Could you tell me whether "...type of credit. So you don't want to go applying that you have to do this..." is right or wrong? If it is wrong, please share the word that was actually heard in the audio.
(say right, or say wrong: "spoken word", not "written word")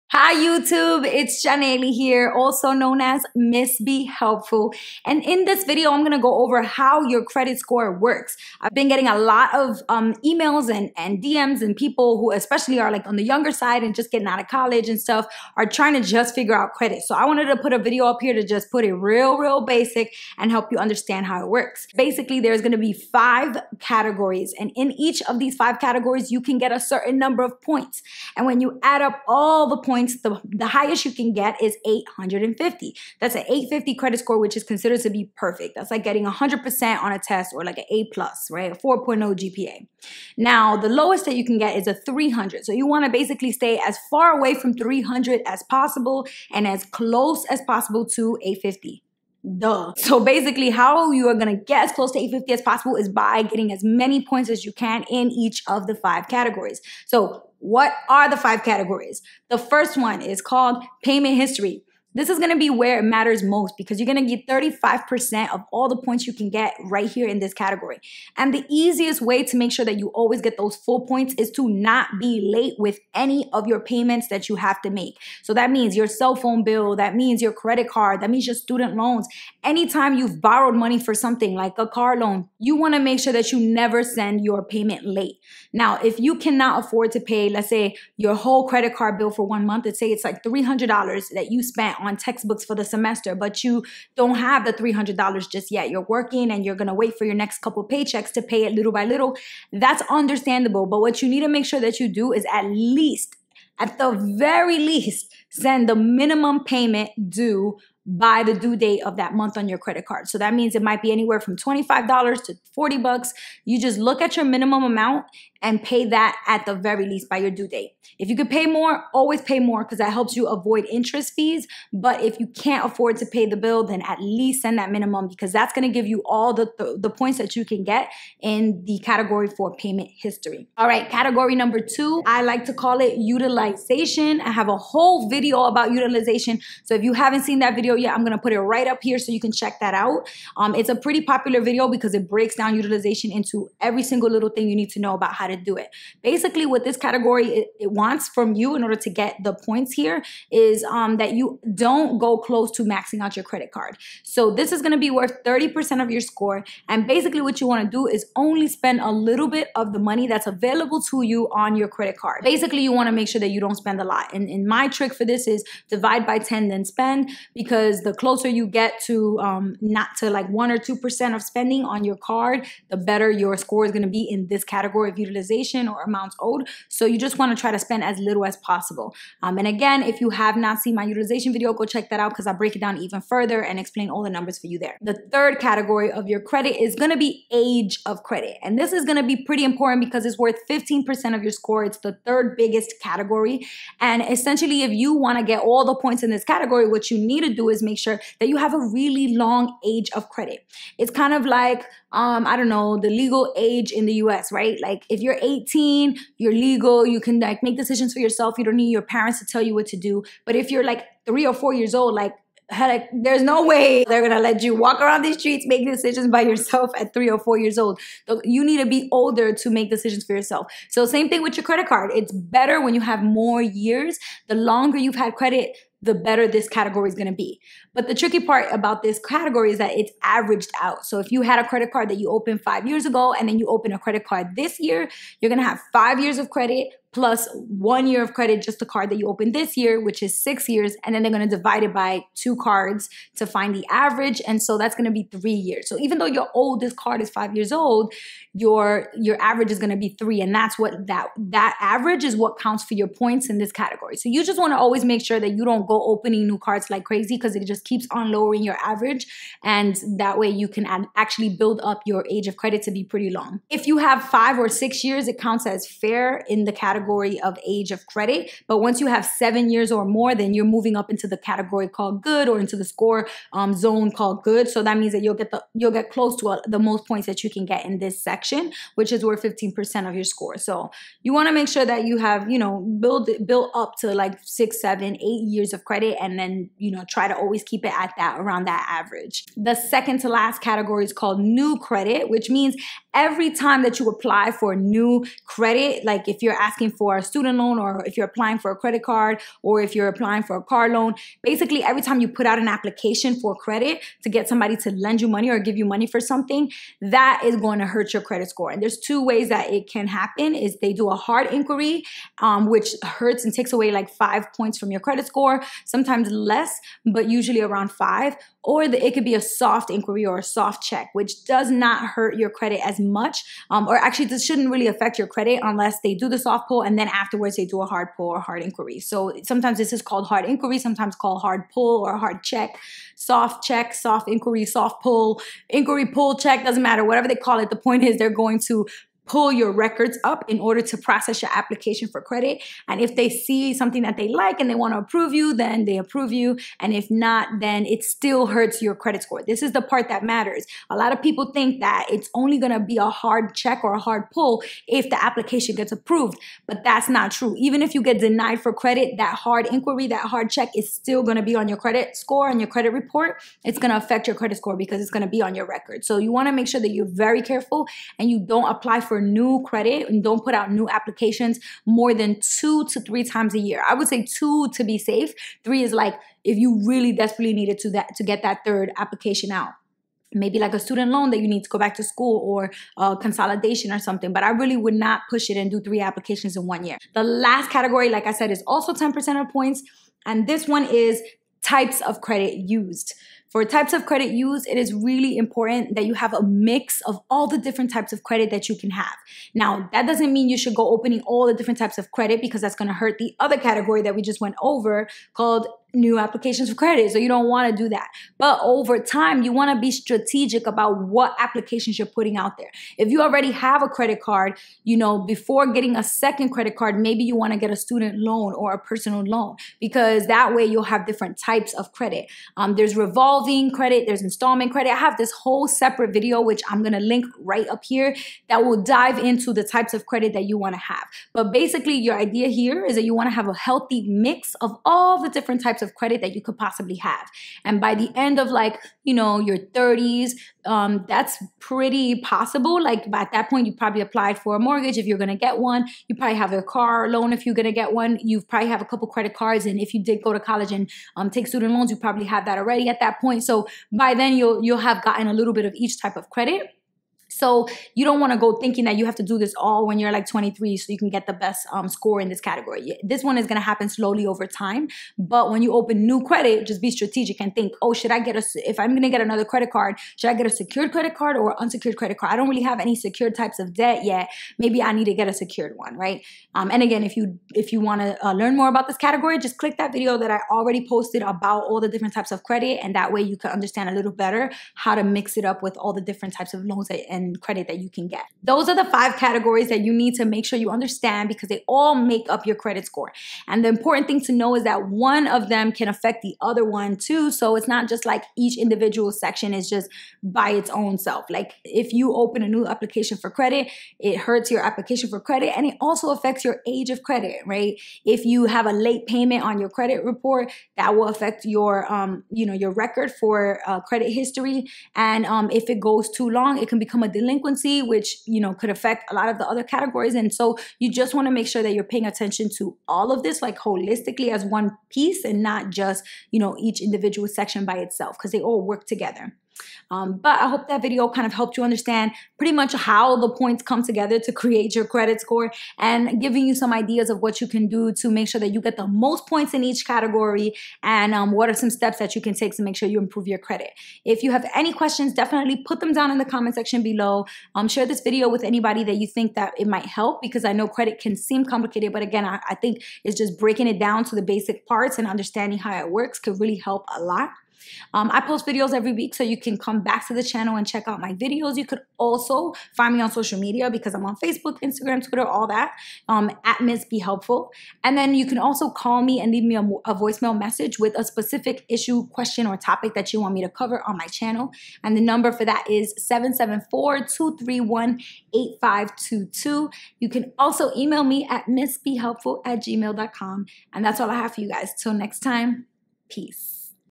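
wrong: "thinking", not "applying".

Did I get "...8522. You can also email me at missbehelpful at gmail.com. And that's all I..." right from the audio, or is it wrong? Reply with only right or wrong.
right.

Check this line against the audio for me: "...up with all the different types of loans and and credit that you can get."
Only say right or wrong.
right.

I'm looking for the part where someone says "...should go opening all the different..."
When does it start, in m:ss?
6:40.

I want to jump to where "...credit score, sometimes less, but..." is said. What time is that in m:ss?
5:14.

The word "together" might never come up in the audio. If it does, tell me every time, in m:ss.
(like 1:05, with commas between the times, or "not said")
8:48, 8:53.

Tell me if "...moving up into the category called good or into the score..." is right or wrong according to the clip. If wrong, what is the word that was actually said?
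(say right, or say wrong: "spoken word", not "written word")
right.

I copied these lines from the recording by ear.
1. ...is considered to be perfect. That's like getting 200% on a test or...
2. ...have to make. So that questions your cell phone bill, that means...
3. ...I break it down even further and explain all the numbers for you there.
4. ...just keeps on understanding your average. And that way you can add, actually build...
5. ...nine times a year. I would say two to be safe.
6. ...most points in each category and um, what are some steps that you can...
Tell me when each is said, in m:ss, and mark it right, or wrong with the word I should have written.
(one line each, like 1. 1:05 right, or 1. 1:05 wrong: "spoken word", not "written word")
1. 0:34 wrong: "100", not "200"
2. 1:14 wrong: "means", not "questions"
3. 3:02 right
4. 4:17 wrong: "lowering", not "understanding"
5. 6:12 wrong: "three", not "nine"
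6. 8:58 right.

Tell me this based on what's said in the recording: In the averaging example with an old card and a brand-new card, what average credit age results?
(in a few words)
3 years.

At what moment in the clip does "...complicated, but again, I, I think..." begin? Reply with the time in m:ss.
9:11.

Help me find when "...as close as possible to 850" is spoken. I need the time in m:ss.
0:46.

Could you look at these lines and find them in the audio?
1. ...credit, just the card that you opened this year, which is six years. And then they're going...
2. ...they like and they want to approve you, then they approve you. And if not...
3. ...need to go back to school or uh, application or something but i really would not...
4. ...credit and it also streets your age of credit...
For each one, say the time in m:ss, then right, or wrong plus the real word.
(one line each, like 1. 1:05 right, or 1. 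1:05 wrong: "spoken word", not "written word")
1. 3:58 right
2. 5:44 right
3. 6:21 wrong: "consolidation", not "application"
4. 8:25 wrong: "affects", not "streets".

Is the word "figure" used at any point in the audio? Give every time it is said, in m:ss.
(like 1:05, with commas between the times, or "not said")
0:16.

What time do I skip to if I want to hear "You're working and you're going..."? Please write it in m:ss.
1:35.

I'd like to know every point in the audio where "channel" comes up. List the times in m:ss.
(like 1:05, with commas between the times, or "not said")
9:20, 9:34.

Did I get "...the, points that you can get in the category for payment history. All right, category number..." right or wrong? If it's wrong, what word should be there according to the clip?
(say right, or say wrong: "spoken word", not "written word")
right.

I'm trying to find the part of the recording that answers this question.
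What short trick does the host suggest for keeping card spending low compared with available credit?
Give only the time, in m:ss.
2:45.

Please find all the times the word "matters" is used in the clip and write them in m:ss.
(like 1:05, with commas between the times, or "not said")
1:03, 5:36, 5:50.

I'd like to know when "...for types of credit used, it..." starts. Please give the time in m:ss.
6:33.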